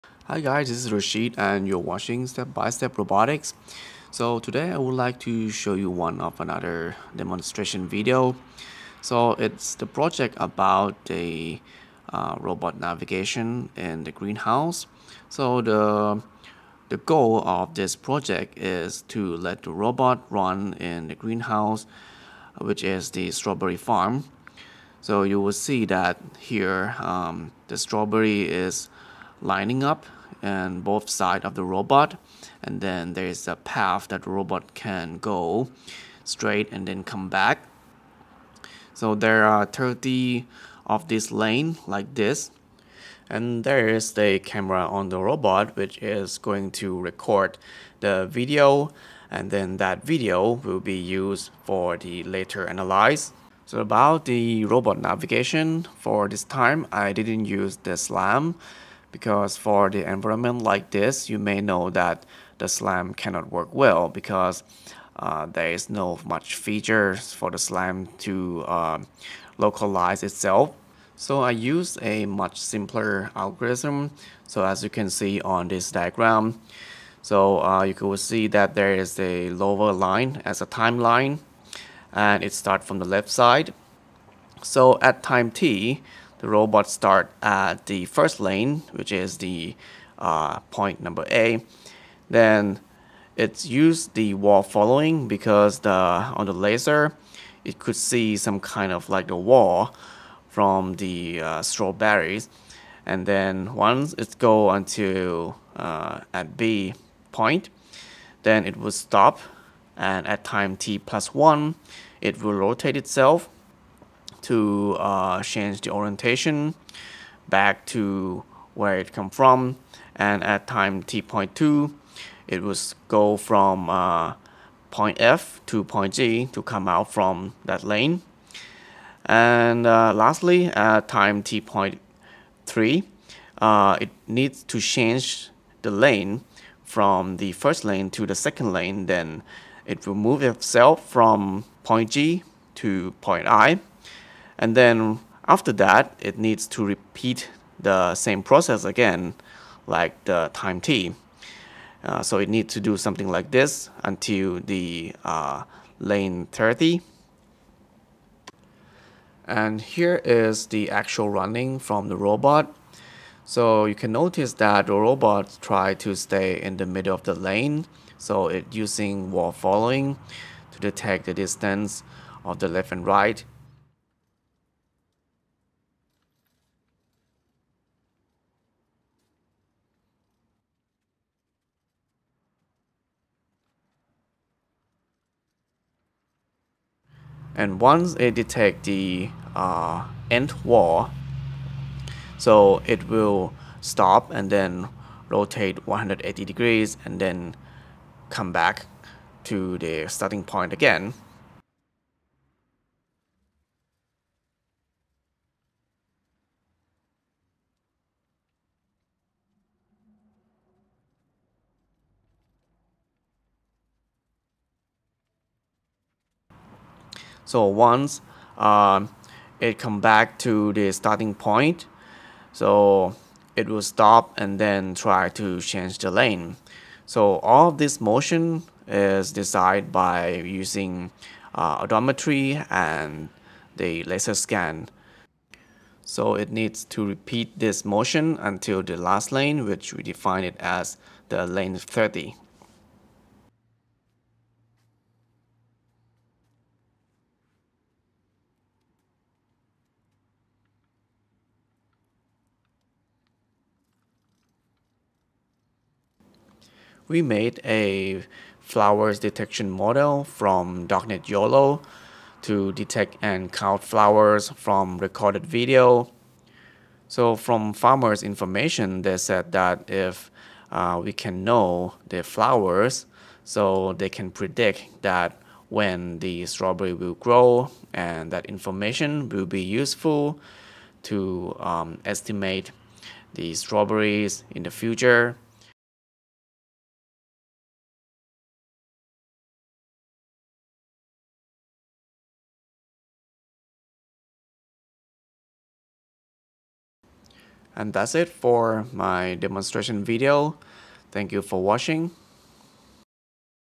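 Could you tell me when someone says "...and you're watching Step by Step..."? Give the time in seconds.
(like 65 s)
1 s.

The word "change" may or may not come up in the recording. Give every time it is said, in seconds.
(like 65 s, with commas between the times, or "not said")
115 s, 134 s, 225 s.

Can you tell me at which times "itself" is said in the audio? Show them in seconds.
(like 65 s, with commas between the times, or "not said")
70 s, 112 s, 140 s.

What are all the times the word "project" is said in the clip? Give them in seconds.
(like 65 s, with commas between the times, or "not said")
9 s, 17 s.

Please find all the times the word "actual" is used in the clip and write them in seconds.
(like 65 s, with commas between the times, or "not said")
160 s.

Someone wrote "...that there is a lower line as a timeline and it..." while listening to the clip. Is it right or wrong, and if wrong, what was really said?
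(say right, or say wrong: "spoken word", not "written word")
right.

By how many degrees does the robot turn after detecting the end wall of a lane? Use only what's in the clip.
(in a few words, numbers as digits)
180.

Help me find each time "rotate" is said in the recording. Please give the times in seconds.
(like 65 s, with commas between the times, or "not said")
112 s, 195 s.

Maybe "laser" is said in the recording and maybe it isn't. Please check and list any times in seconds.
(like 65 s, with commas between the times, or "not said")
96 s, 234 s.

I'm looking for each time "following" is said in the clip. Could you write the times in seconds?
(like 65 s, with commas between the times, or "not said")
94 s, 169 s.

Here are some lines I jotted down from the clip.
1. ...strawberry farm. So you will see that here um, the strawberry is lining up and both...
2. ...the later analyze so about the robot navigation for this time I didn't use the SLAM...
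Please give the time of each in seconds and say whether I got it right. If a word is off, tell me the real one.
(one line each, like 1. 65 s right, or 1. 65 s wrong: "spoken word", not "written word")
1. 23 s right
2. 51 s right.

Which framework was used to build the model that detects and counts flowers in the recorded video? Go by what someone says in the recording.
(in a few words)
Darknet YOLO.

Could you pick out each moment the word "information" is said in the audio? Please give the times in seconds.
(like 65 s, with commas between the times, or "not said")
268 s, 278 s.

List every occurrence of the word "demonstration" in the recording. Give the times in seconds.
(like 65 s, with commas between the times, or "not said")
7 s, 299 s.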